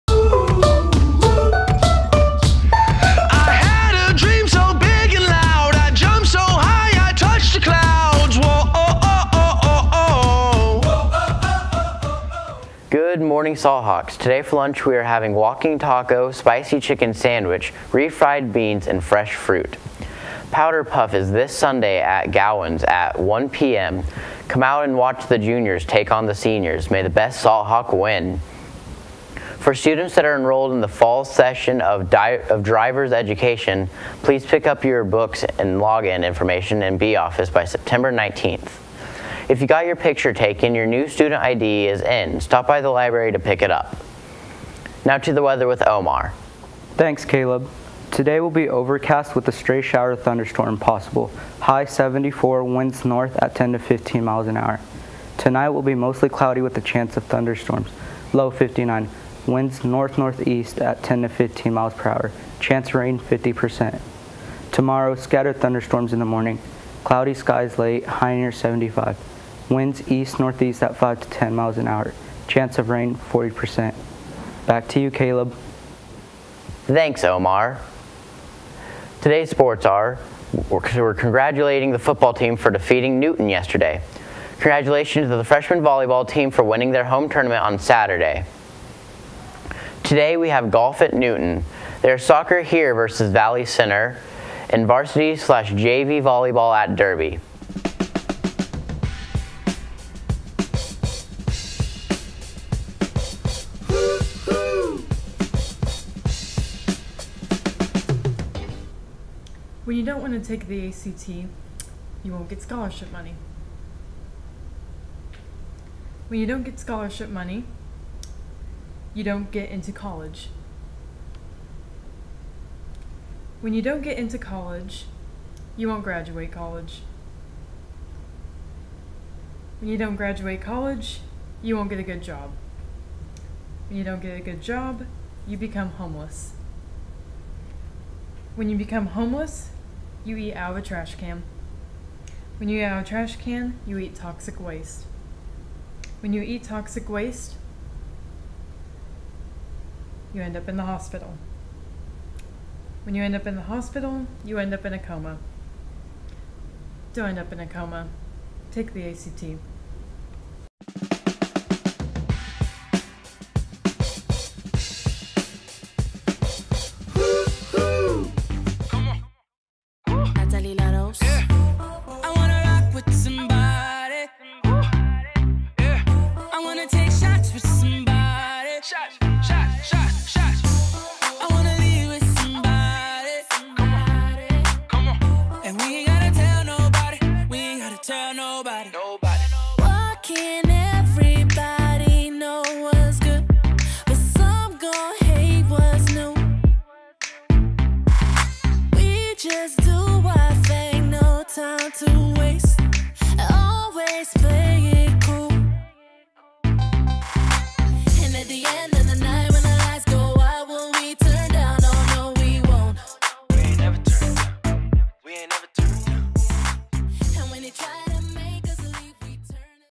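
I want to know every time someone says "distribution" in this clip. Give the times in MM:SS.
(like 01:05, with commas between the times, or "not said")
not said.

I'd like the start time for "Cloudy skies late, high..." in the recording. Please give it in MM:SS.
01:07.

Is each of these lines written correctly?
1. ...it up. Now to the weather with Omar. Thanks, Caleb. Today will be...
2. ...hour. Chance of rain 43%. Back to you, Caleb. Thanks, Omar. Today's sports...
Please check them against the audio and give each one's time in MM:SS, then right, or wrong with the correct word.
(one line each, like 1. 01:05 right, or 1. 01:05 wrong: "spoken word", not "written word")
1. 00:43 right
2. 01:11 wrong: "40", not "43".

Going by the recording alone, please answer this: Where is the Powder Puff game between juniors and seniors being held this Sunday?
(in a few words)
Gowan's.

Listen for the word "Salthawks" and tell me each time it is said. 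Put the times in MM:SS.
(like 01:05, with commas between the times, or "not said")
00:13, 00:27.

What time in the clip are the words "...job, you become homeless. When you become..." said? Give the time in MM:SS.
02:14.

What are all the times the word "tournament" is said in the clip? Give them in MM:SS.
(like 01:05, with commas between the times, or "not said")
01:27.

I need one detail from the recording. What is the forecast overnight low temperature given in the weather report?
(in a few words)
59.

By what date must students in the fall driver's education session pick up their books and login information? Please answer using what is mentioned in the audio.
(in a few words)
September 19th.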